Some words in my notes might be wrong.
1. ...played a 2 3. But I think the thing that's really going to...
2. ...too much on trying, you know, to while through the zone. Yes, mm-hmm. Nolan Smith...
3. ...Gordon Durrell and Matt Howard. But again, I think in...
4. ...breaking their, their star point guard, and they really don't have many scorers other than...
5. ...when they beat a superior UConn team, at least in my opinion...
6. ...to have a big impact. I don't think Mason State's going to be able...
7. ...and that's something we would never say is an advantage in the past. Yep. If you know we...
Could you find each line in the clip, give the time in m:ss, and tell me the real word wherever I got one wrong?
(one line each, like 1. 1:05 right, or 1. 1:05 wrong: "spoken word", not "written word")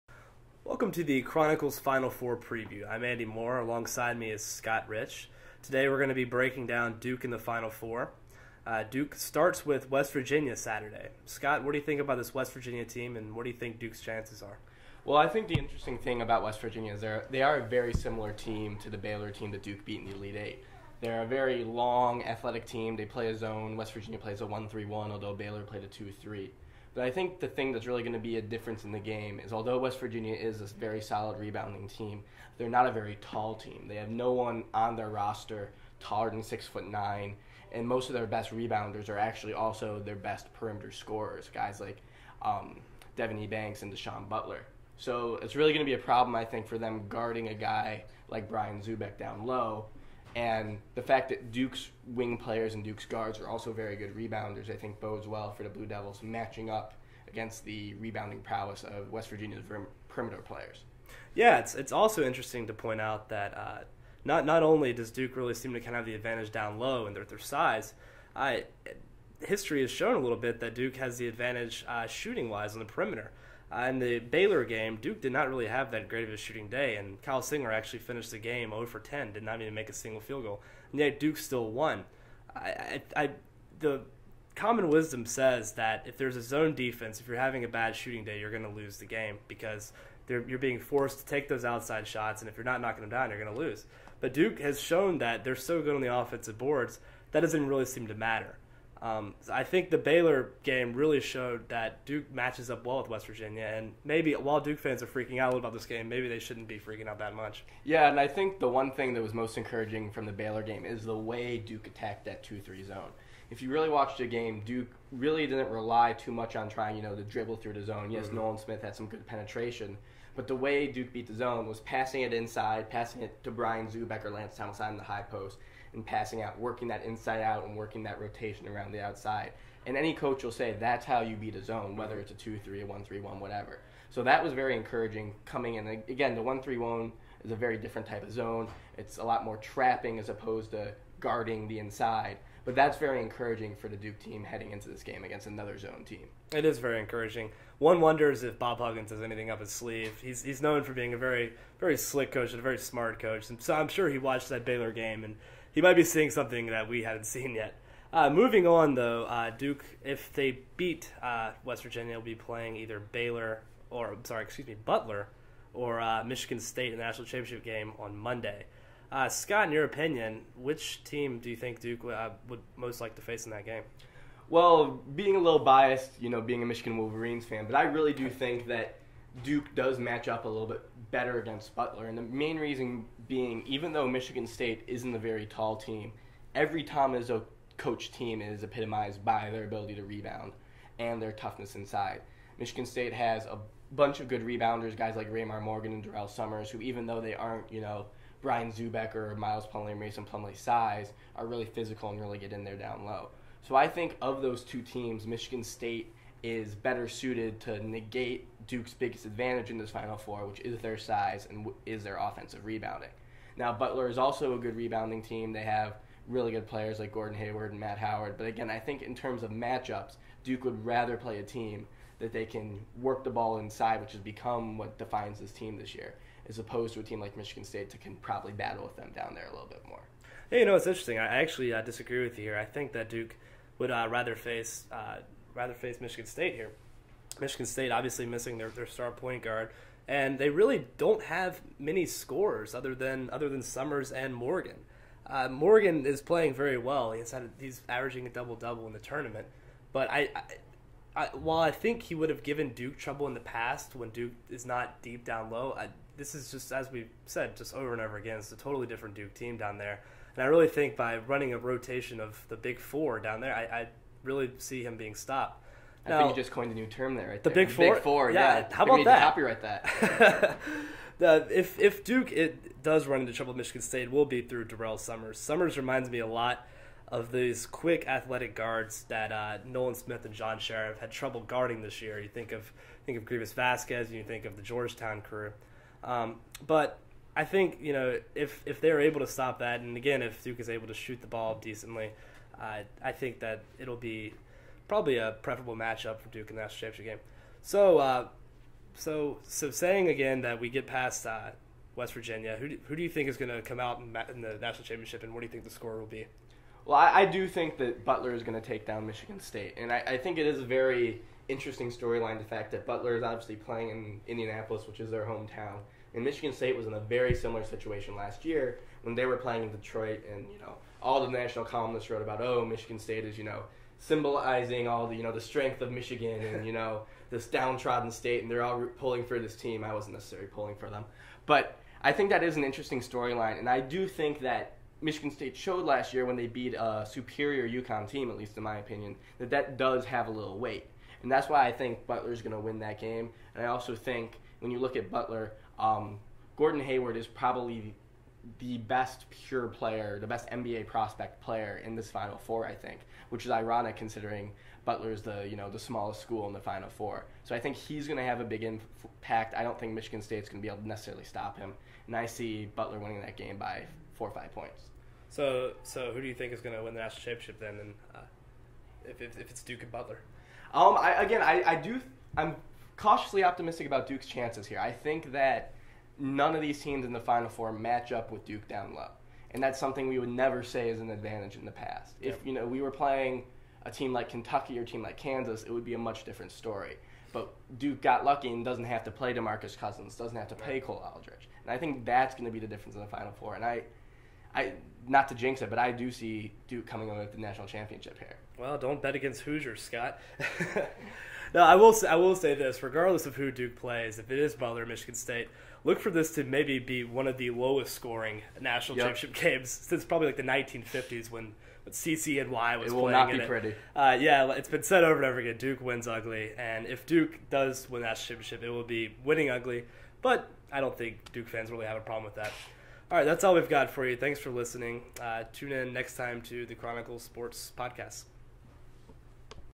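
1. 0:25 right
2. 1:56 wrong: "dribble", not "while"
3. 3:37 wrong: "Hayward", not "Durrell"
4. 3:58 wrong: "missing", not "breaking"
5. 5:36 right
6. 5:58 wrong: "Michigan", not "Mason"
7. 6:19 right.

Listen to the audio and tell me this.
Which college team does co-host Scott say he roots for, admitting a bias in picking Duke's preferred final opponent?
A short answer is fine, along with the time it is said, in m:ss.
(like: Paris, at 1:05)
Michigan Wolverines, at 2:56.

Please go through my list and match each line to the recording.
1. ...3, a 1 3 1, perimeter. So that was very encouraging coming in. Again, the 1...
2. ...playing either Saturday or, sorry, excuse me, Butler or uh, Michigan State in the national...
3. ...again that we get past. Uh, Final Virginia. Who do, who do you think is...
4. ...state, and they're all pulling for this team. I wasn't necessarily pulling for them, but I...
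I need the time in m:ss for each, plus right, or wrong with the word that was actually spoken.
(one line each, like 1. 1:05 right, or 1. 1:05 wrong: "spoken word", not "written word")
1. 2:12 wrong: "whatever", not "perimeter"
2. 2:42 wrong: "Baylor", not "Saturday"
3. 5:00 wrong: "West", not "Final"
4. 5:28 right.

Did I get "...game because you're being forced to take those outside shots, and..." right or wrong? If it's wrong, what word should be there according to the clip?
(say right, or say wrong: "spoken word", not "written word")
right.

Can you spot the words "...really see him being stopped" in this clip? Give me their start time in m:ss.
4:24.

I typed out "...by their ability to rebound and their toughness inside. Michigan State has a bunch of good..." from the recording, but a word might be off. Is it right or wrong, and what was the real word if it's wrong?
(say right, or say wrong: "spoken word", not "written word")
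right.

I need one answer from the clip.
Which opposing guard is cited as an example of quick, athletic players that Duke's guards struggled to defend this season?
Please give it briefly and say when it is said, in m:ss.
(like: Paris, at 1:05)
Greivis Vasquez, at 4:43.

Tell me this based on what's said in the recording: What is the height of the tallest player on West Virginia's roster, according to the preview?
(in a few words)
six foot nine.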